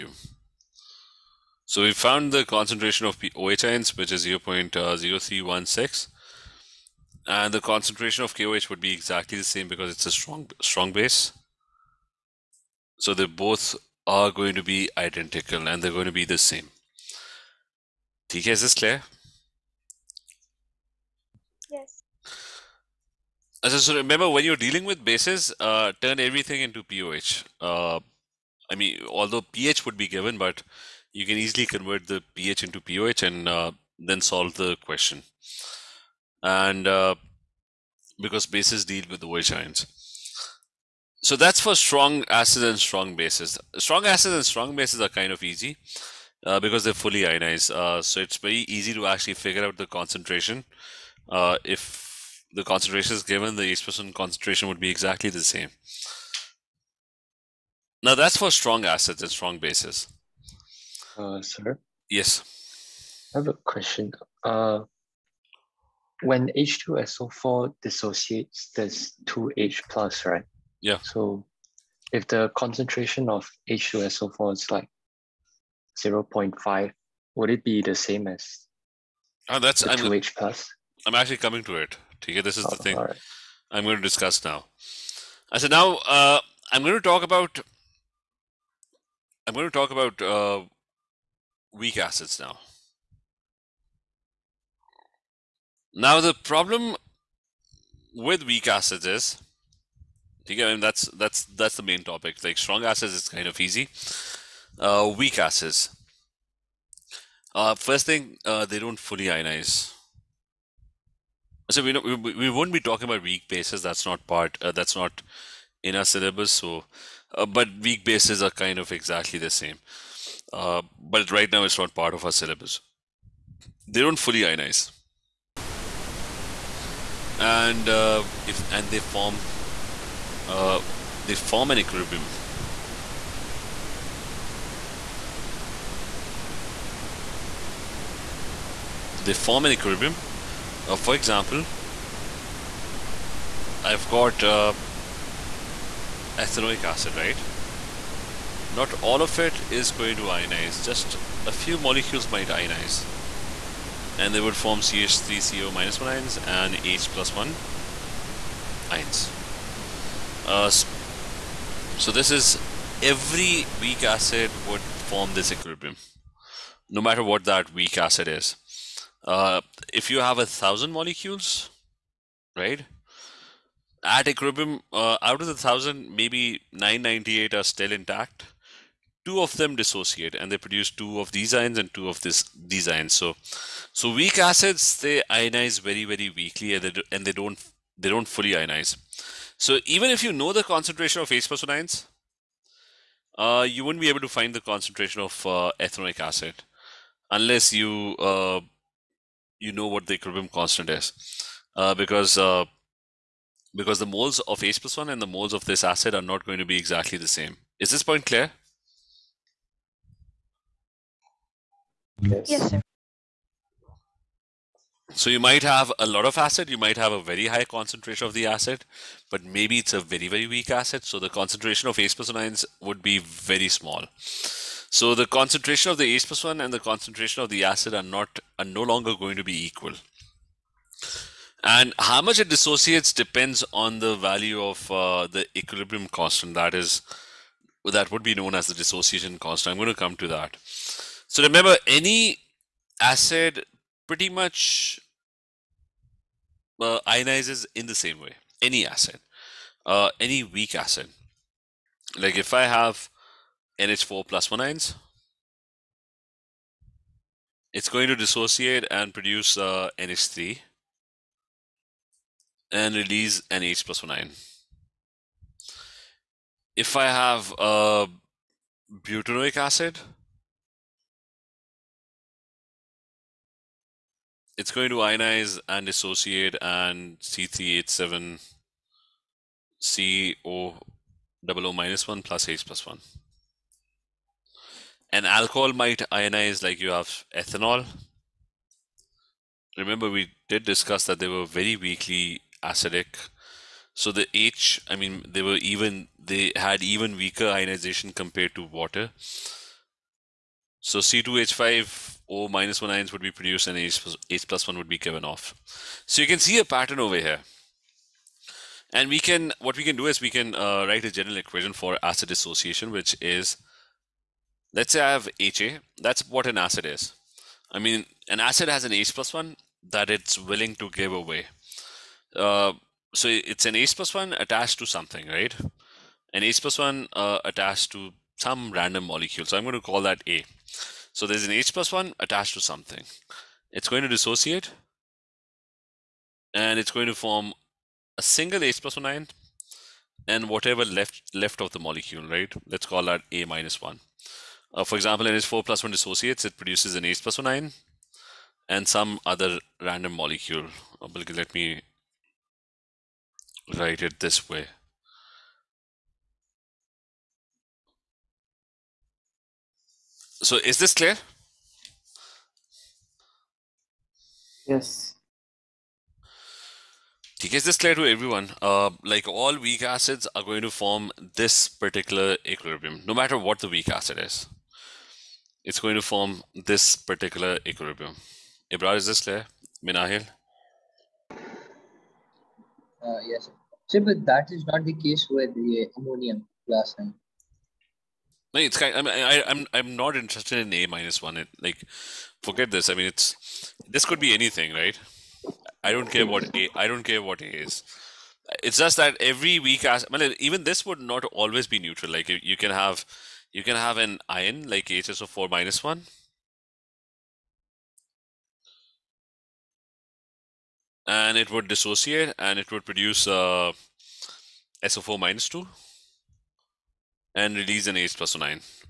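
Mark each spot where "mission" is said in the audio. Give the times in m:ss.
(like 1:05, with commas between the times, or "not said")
not said.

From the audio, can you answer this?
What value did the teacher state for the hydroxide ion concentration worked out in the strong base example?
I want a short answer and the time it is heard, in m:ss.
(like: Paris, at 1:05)
0.0316, at 0:04.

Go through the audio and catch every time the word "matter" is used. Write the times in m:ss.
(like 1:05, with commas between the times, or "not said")
2:47, 6:13.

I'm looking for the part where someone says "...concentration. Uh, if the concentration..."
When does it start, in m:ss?
0:49.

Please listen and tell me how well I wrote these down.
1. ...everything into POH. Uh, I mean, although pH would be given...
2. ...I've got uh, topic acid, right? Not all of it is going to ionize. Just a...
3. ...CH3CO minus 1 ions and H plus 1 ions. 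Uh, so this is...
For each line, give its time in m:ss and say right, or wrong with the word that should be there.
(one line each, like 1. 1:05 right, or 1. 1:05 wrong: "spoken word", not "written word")
1. 0:26 right
2. 2:23 wrong: "ethanoic", not "topic"
3. 2:34 right.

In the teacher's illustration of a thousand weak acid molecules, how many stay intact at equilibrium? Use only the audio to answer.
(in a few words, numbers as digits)
998.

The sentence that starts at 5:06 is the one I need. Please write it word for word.
So you can see a pattern over here.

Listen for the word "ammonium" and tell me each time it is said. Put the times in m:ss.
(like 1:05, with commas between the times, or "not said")
6:25.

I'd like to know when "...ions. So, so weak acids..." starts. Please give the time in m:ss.
3:02.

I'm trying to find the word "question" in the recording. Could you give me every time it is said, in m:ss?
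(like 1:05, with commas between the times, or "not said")
0:34, 1:03.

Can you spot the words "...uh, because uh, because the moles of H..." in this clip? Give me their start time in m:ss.
3:21.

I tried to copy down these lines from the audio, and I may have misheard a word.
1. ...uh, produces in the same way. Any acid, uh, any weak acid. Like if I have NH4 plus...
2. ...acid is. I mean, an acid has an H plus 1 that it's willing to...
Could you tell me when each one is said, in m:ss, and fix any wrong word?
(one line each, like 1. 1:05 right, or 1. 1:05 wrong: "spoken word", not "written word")
1. 4:06 wrong: "ionizes", not "produces"
2. 5:16 right.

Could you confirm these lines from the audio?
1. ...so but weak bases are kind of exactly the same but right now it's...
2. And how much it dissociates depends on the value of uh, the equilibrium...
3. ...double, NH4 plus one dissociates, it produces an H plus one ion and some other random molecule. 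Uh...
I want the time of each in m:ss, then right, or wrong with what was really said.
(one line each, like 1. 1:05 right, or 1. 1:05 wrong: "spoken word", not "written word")
1. 1:56 right
2. 3:51 right
3. 5:44 wrong: "example", not "double".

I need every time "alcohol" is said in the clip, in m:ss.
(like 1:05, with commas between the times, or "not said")
4:45.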